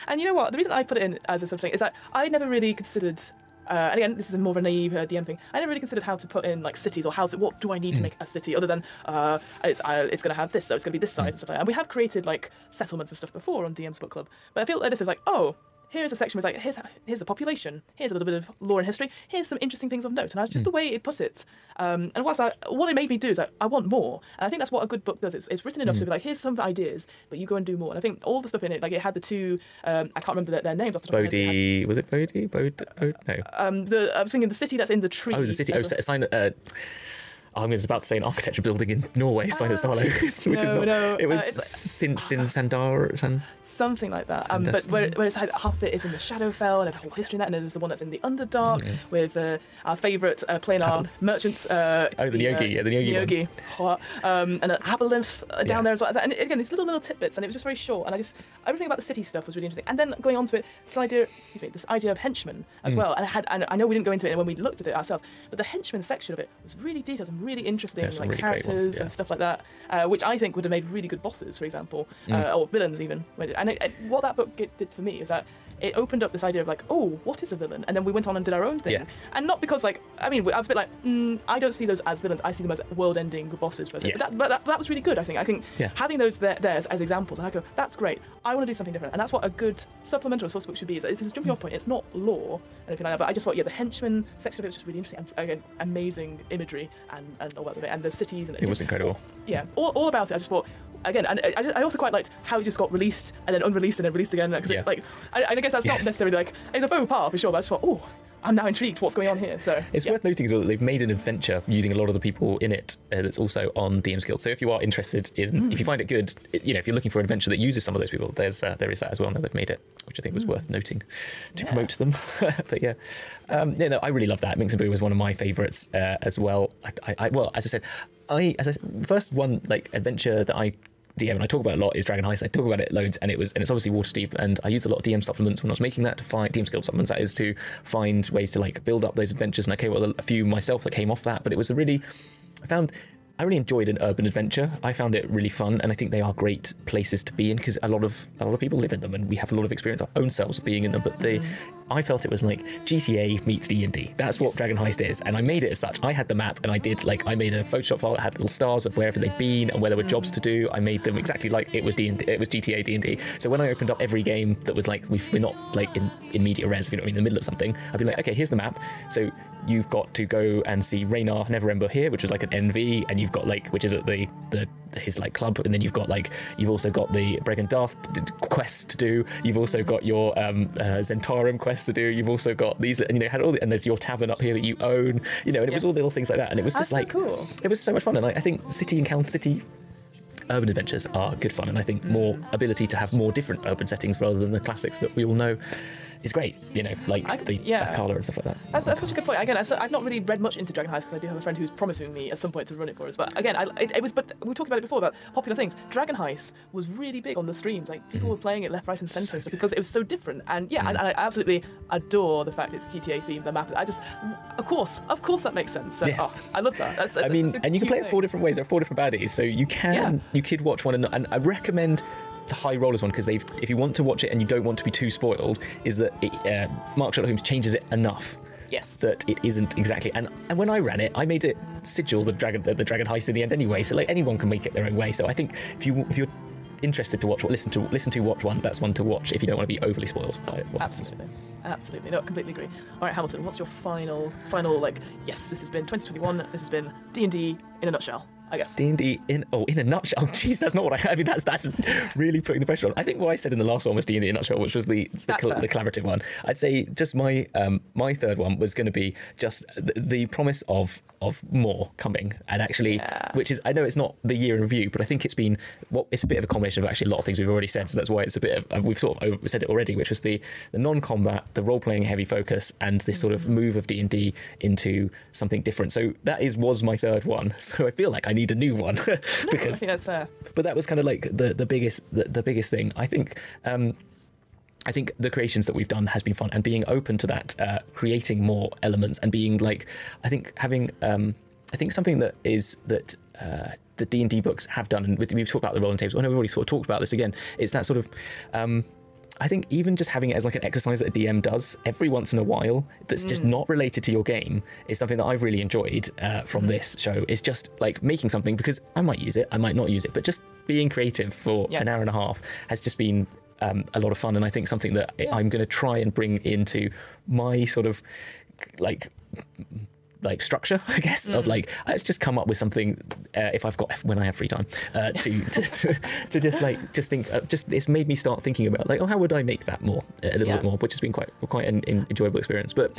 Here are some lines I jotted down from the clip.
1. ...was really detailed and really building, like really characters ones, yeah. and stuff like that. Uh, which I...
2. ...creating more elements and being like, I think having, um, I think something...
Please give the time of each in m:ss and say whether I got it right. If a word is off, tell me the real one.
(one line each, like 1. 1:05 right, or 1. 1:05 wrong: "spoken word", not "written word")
1. 1:06 wrong: "interesting", not "building"
2. 4:47 right.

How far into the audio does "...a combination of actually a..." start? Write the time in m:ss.
4:26.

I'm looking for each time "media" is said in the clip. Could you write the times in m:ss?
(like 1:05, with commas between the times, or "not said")
2:46.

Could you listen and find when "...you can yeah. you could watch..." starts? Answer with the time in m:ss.
3:39.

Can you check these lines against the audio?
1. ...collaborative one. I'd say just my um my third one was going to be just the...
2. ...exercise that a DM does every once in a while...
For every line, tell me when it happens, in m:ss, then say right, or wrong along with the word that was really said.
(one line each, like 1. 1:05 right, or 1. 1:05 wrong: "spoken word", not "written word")
1. 4:15 right
2. 5:00 right.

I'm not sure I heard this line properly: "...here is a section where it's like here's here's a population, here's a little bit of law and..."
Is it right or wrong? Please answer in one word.
right.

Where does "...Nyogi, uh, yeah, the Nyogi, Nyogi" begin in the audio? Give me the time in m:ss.
0:52.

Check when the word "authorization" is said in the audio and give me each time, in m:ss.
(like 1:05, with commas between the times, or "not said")
not said.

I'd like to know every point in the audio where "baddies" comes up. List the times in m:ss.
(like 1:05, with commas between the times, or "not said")
3:38.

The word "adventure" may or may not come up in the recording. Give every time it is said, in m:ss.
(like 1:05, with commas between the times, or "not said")
1:51, 1:57, 2:09, 2:19, 2:24, 3:10.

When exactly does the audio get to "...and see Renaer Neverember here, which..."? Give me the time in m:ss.
2:50.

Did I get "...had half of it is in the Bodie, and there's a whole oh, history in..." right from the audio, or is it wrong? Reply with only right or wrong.
wrong.